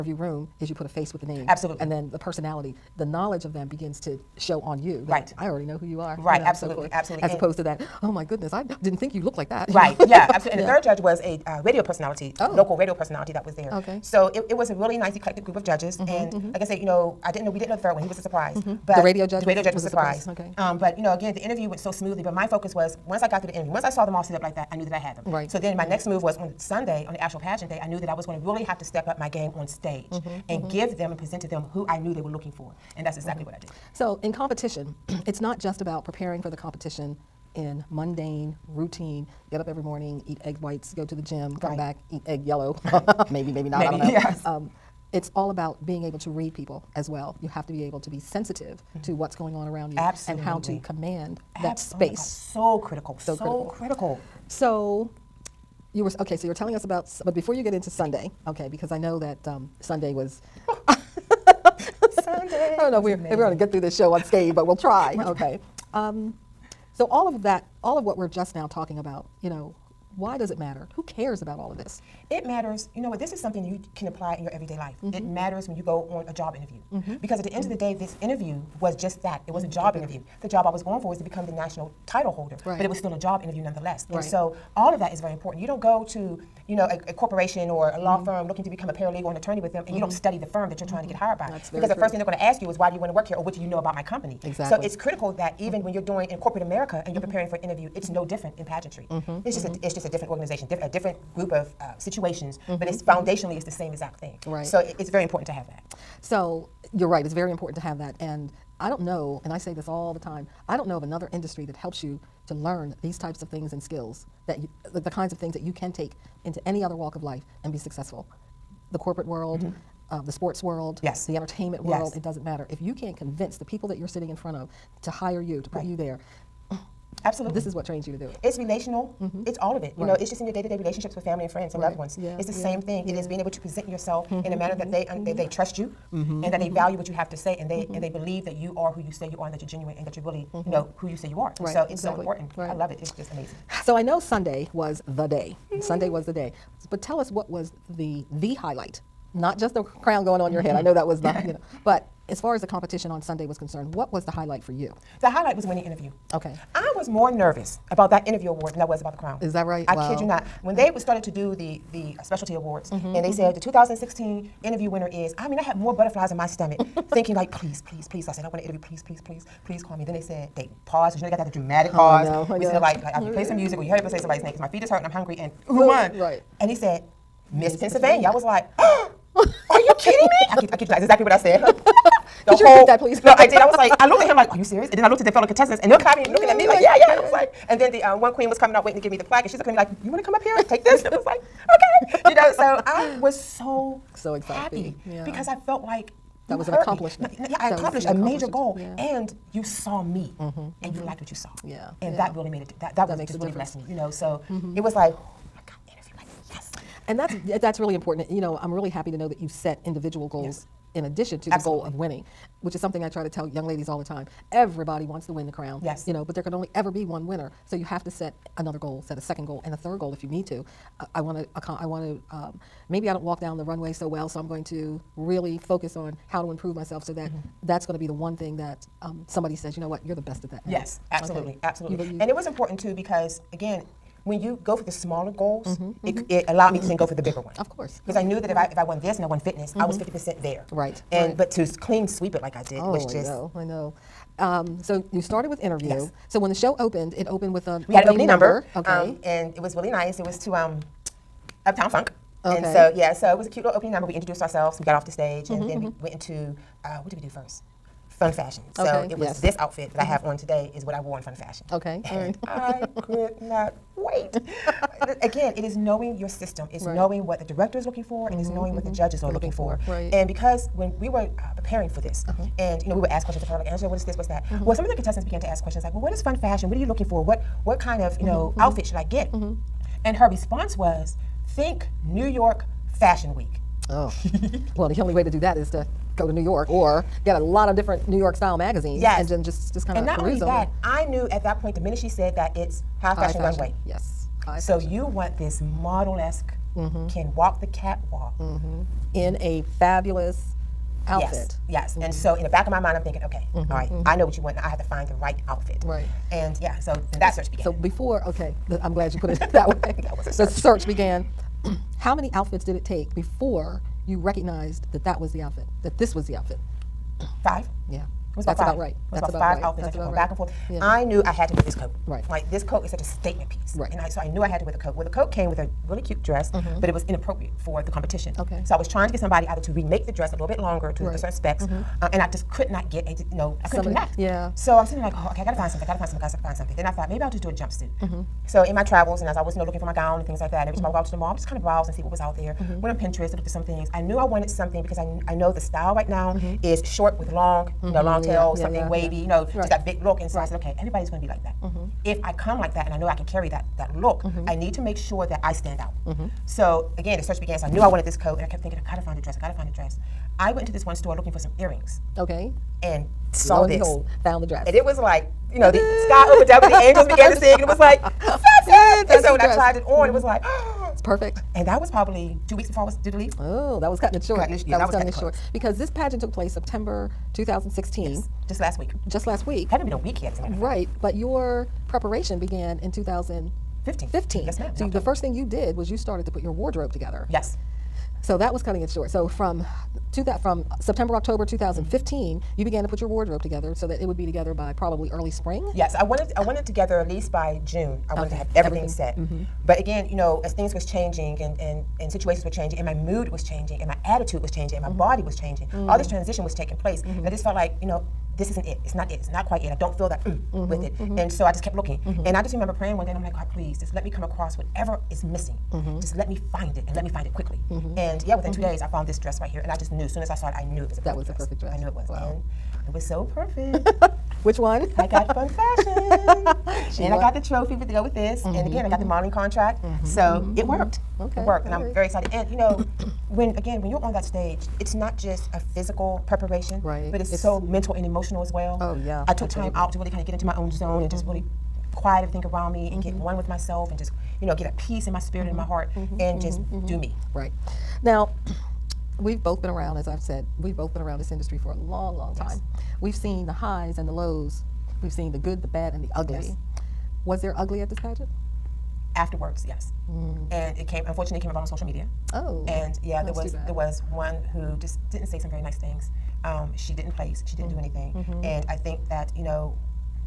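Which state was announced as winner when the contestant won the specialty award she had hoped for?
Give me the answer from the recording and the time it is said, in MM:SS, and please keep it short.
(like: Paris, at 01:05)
Pennsylvania, at 02:57.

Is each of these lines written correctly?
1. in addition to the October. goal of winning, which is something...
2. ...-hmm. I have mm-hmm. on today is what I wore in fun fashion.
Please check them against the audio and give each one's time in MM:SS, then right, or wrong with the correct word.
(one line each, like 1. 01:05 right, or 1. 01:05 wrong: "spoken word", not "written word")
1. 03:30 wrong: "Absolutely", not "October"
2. 04:19 right.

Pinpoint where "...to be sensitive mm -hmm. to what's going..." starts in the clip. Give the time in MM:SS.
00:48.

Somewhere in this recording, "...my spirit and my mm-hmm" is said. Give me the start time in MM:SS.
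07:25.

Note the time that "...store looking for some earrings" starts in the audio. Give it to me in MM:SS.
06:00.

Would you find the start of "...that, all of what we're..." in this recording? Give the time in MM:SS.
01:07.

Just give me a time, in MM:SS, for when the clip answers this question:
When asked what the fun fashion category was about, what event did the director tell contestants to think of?
04:42.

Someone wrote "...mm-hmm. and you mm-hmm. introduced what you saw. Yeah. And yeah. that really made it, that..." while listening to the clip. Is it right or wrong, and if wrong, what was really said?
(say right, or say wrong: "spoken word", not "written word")
wrong: "liked", not "introduced".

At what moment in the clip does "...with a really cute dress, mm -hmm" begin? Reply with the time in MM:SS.
05:25.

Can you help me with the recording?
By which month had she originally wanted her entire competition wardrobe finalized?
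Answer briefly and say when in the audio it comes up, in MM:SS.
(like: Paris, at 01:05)
June, at 06:37.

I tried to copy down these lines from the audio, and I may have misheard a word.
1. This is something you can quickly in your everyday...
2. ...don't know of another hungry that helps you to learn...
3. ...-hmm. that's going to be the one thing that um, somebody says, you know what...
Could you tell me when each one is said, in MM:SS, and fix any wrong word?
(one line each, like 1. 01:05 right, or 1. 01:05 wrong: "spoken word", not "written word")
1. 01:13 wrong: "apply", not "quickly"
2. 01:50 wrong: "industry", not "hungry"
3. 03:47 right.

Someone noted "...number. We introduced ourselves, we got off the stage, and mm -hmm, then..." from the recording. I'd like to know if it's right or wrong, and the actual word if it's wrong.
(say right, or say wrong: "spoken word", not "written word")
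right.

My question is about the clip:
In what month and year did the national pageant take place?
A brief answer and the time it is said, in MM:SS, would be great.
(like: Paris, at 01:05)
September 2016, at 06:16.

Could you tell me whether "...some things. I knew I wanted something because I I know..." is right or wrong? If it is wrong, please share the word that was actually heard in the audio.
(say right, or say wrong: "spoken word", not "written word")
right.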